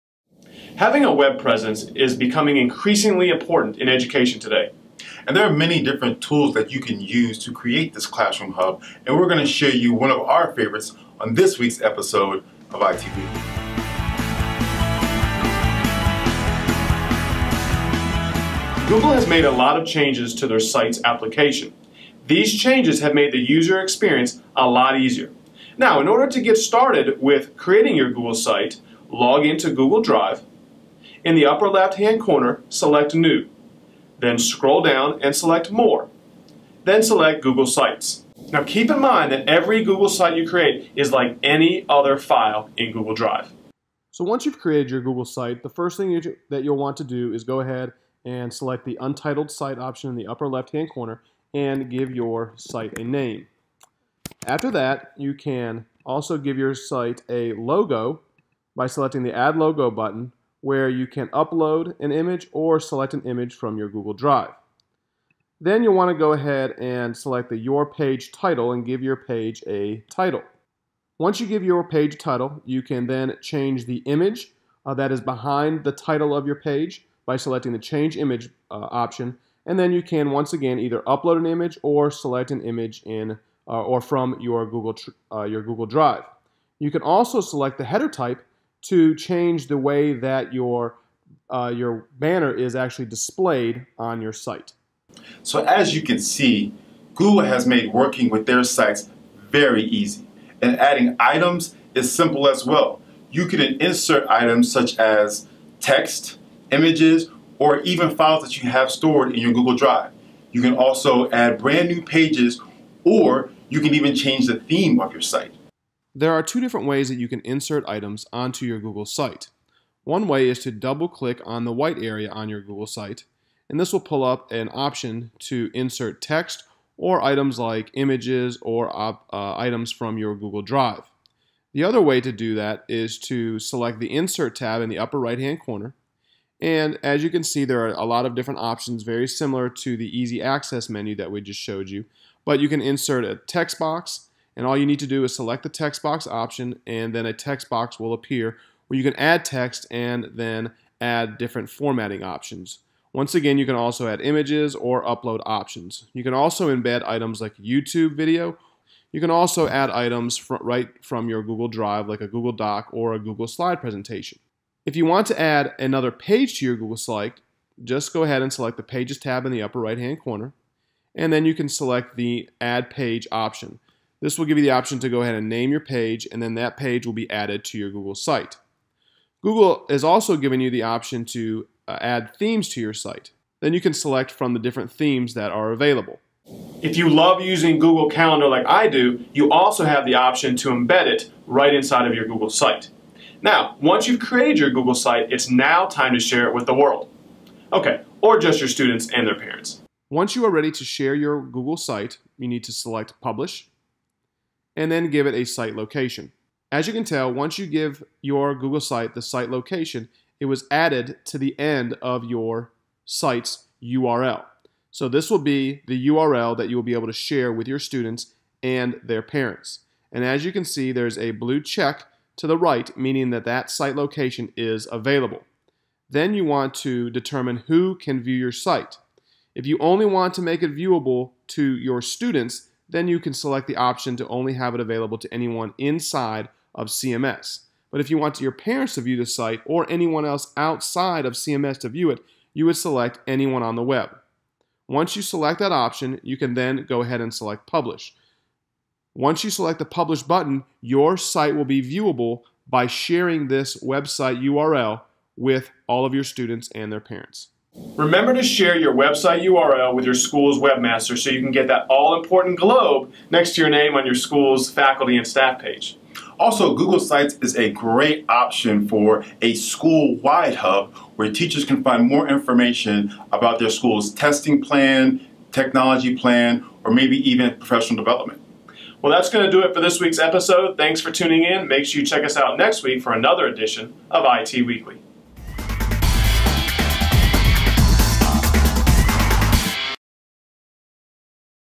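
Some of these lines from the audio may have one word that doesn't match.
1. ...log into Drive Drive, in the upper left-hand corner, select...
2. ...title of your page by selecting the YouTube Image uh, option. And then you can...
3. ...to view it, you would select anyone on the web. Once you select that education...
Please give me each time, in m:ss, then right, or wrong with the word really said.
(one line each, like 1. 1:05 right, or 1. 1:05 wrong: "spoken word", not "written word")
1. 0:29 wrong: "Google", not "Drive"
2. 1:15 wrong: "Change", not "YouTube"
3. 4:01 wrong: "option", not "education".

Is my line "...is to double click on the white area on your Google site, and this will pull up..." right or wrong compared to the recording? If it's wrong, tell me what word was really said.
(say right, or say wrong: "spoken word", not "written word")
right.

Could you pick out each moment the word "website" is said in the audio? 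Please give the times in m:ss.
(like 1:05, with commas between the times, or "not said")
4:13, 4:18.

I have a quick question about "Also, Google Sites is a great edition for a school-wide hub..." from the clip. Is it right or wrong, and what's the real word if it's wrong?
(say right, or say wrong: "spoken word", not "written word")
wrong: "option", not "edition".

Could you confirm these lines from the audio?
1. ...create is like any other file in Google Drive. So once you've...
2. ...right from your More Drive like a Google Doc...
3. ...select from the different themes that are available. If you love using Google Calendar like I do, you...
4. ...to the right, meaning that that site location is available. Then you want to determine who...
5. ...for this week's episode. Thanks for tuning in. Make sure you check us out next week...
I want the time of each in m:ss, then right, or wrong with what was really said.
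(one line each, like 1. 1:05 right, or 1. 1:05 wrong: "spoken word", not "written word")
1. 0:40 right
2. 2:40 wrong: "Google", not "More"
3. 3:03 right
4. 3:42 right
5. 4:39 right.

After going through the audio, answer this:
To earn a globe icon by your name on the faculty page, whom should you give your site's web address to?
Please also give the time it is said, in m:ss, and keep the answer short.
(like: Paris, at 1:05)
school's webmaster, at 4:20.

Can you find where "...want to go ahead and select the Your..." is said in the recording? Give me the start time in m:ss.
1:05.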